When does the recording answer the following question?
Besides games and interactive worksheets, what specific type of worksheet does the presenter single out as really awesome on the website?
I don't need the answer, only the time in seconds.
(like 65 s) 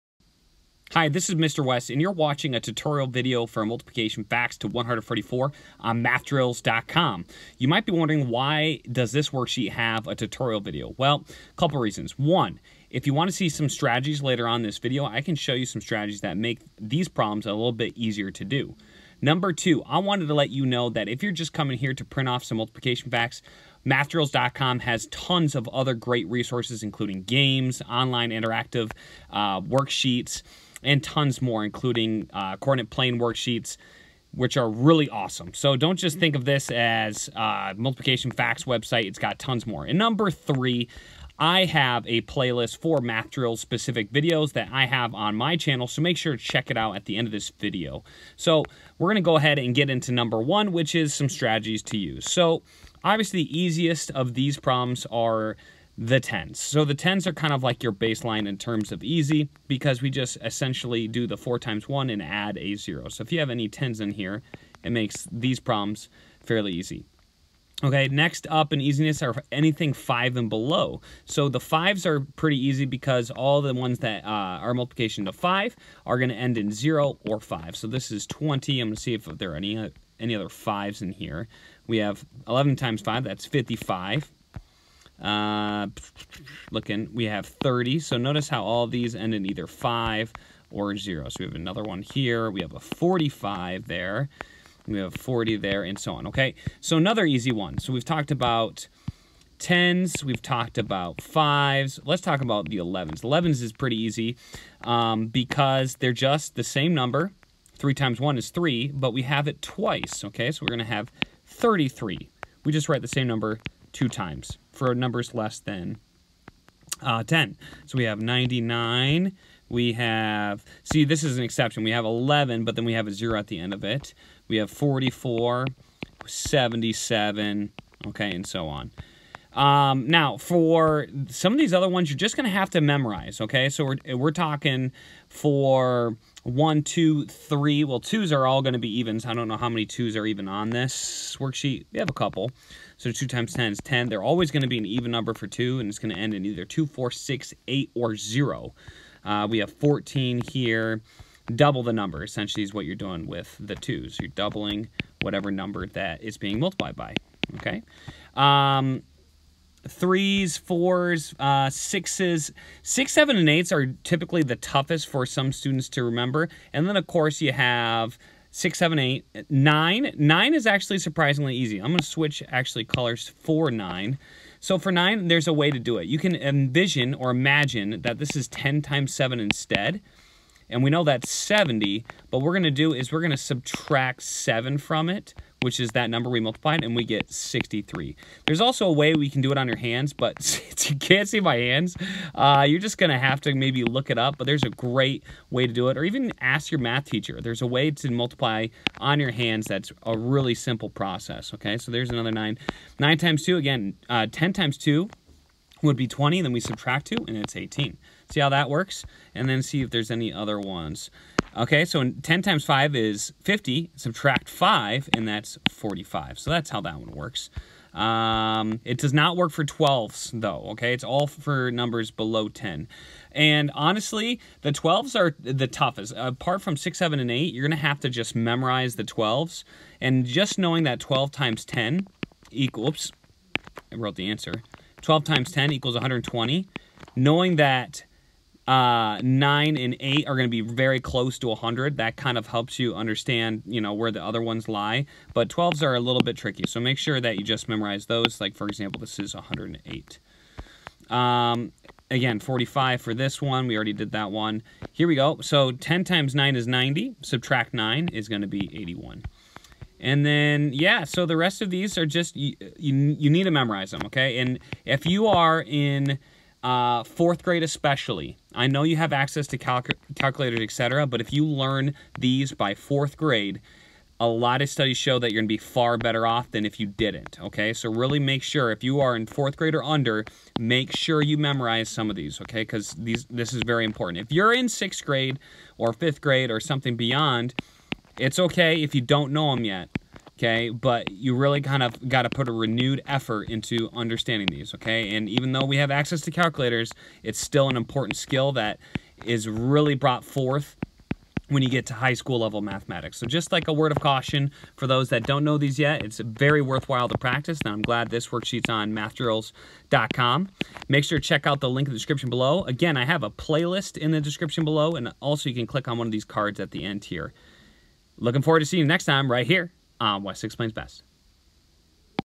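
32 s.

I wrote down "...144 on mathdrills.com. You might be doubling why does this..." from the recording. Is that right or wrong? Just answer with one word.
wrong.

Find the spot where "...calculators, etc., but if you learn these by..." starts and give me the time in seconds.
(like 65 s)
270 s.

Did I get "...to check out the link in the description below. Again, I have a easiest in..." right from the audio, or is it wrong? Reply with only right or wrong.
wrong.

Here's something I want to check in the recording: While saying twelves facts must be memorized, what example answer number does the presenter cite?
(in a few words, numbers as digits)
108.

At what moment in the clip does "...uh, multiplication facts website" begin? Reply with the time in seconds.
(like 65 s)
37 s.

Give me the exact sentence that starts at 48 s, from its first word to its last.
So we're gonna go ahead and get into number one, which is some strategies to use.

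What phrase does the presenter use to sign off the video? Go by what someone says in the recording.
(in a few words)
West Six Explains Best.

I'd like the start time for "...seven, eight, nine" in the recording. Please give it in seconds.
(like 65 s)
168 s.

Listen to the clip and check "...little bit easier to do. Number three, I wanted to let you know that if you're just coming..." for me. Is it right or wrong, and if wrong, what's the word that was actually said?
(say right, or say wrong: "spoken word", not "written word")
wrong: "two", not "three".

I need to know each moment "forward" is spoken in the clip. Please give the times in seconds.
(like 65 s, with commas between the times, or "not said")
318 s.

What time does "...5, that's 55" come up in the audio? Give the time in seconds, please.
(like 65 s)
83 s.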